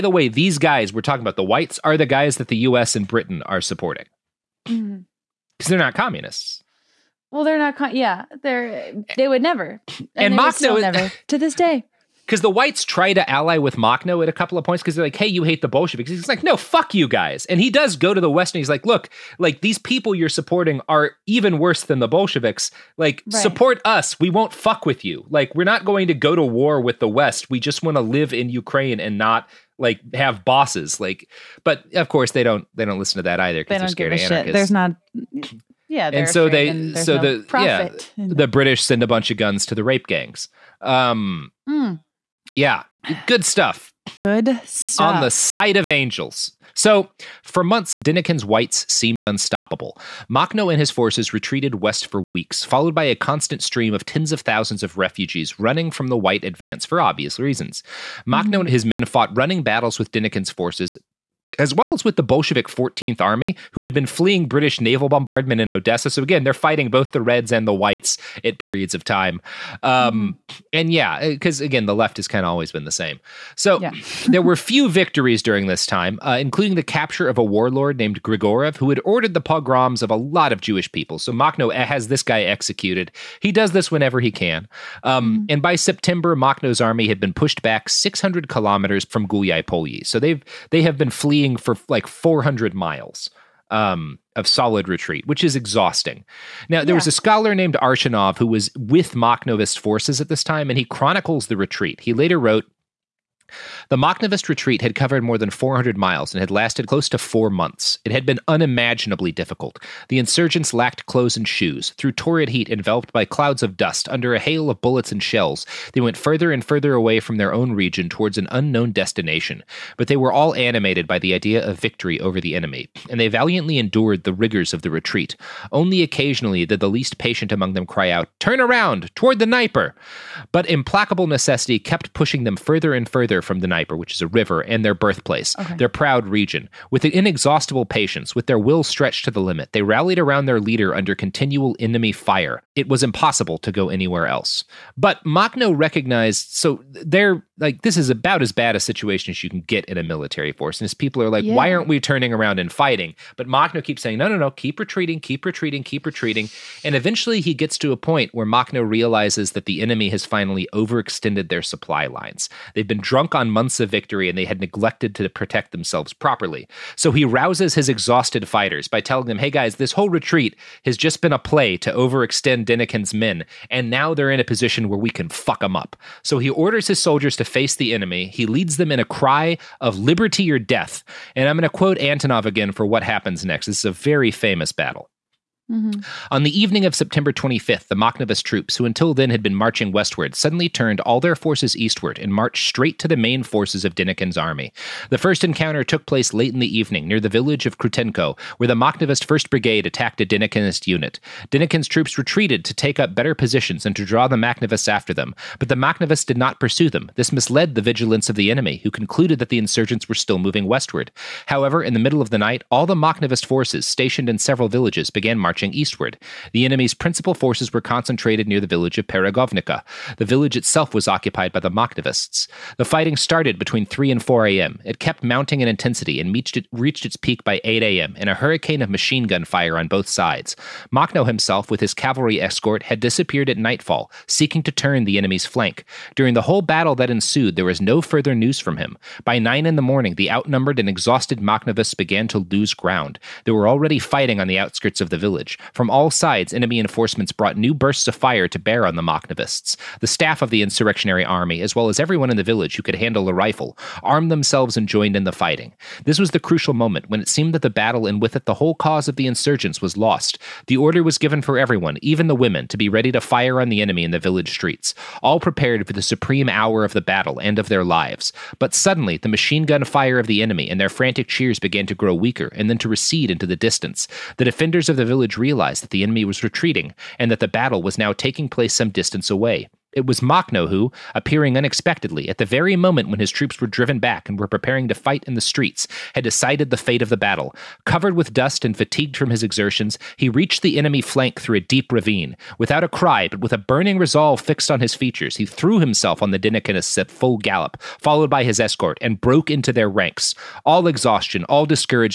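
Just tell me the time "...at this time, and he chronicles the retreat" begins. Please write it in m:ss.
1:40.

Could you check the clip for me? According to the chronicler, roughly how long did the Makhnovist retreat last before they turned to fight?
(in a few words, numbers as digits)
close to four months.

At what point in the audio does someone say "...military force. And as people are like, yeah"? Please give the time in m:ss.
2:30.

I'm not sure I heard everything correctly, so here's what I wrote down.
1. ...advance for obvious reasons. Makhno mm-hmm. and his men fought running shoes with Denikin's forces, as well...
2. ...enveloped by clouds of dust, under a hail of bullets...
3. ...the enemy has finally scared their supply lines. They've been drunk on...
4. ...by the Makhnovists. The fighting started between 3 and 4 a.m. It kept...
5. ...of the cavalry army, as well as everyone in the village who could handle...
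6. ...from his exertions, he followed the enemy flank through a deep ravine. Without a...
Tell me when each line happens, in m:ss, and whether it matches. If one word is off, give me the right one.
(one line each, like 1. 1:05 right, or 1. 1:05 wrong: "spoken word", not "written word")
1. 0:56 wrong: "battles", not "shoes"
2. 1:52 right
3. 2:39 wrong: "overextended", not "scared"
4. 3:41 right
5. 4:10 wrong: "insurrectionary", not "cavalry"
6. 4:49 wrong: "reached", not "followed".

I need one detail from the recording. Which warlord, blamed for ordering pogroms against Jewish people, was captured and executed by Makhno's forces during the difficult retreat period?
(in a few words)
Grigorev.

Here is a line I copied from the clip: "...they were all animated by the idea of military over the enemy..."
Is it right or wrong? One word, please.
wrong.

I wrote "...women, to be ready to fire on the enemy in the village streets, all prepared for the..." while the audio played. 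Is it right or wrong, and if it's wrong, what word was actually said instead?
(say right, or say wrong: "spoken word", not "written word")
right.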